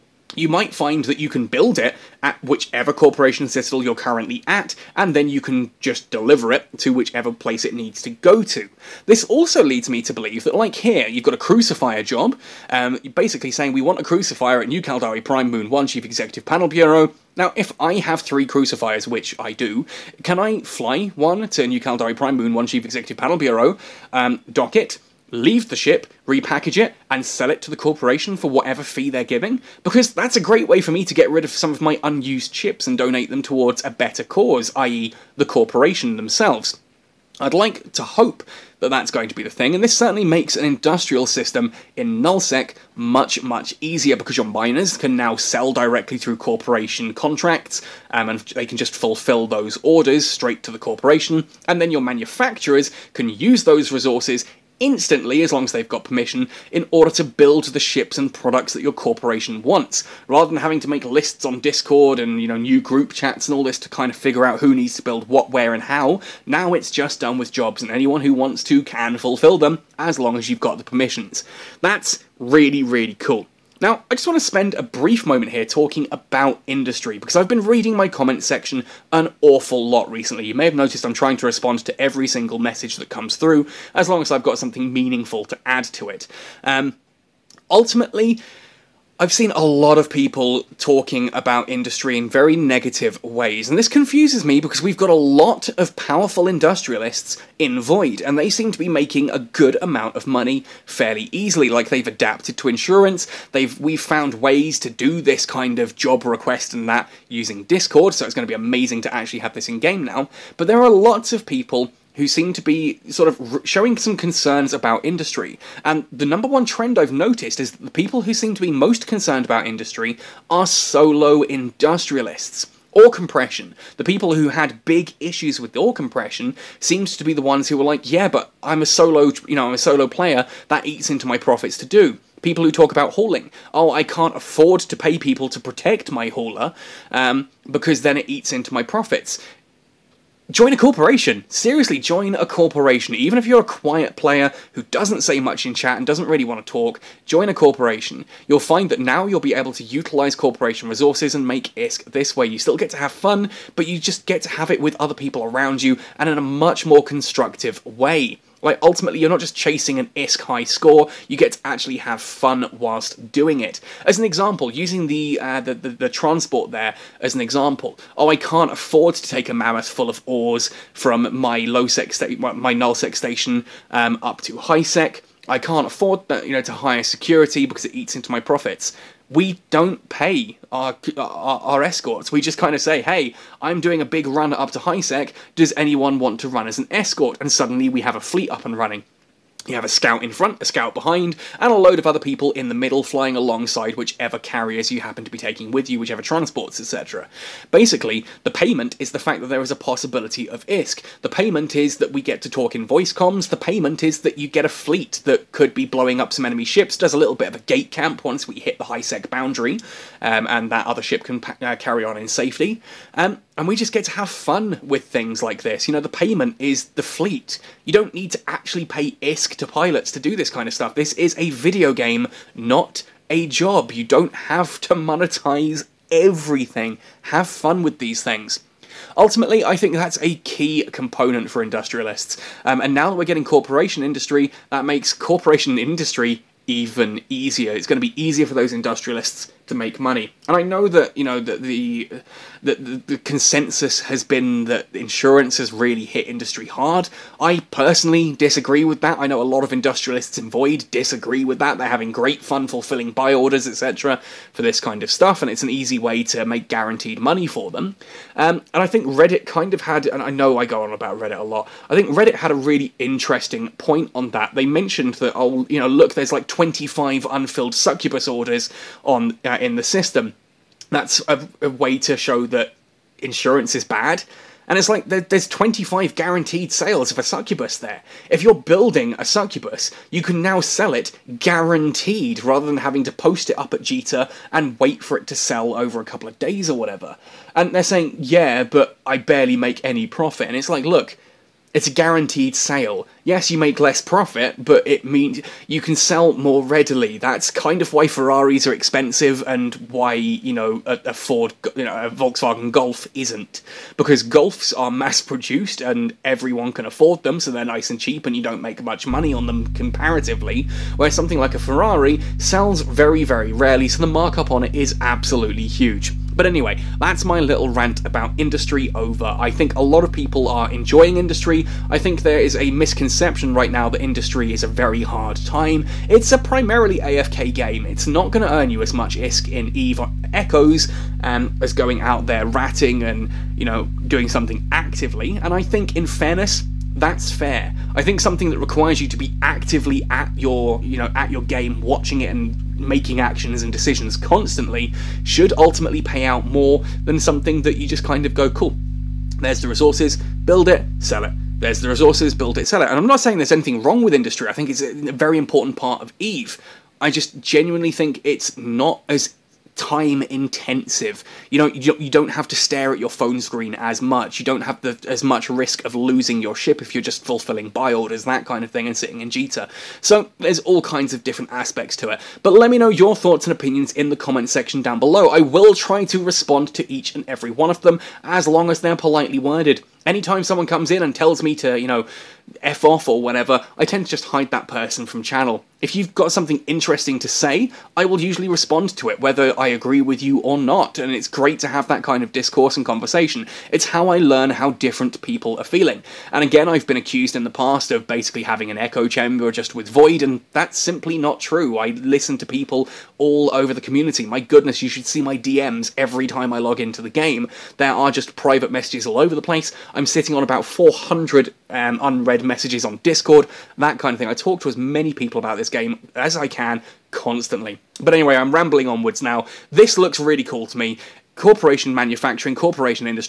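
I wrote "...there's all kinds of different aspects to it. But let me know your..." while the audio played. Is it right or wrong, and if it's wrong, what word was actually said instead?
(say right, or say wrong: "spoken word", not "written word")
right.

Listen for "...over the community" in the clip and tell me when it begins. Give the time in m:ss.
6:43.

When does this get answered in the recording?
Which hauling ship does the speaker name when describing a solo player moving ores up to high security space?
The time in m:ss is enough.
2:49.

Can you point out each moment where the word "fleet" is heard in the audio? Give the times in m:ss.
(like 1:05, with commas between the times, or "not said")
3:08, 3:24, 3:37.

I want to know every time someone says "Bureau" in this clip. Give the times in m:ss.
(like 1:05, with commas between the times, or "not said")
0:16, 0:23.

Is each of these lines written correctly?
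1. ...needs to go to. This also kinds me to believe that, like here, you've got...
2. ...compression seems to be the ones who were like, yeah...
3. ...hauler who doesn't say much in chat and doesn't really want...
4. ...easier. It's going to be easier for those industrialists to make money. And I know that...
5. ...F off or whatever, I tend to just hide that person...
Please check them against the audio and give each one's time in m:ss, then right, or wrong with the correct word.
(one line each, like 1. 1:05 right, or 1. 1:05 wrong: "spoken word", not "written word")
1. 0:07 wrong: "leads", not "kinds"
2. 2:05 right
3. 2:24 wrong: "player", not "hauler"
4. 3:57 right
5. 6:22 right.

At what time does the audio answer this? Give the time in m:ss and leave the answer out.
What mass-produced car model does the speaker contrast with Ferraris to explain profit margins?
5:02.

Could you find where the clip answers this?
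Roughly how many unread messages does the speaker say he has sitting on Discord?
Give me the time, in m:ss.
6:50.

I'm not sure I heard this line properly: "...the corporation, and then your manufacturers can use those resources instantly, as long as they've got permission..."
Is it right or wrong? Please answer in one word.
right.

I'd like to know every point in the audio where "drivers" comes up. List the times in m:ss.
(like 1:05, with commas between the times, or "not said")
not said.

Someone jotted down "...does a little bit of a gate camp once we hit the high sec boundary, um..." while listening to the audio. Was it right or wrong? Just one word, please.
right.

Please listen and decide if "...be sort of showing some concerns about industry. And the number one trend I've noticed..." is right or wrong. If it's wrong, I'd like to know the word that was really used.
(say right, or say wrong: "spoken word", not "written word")
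right.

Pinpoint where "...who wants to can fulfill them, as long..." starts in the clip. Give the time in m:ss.
1:08.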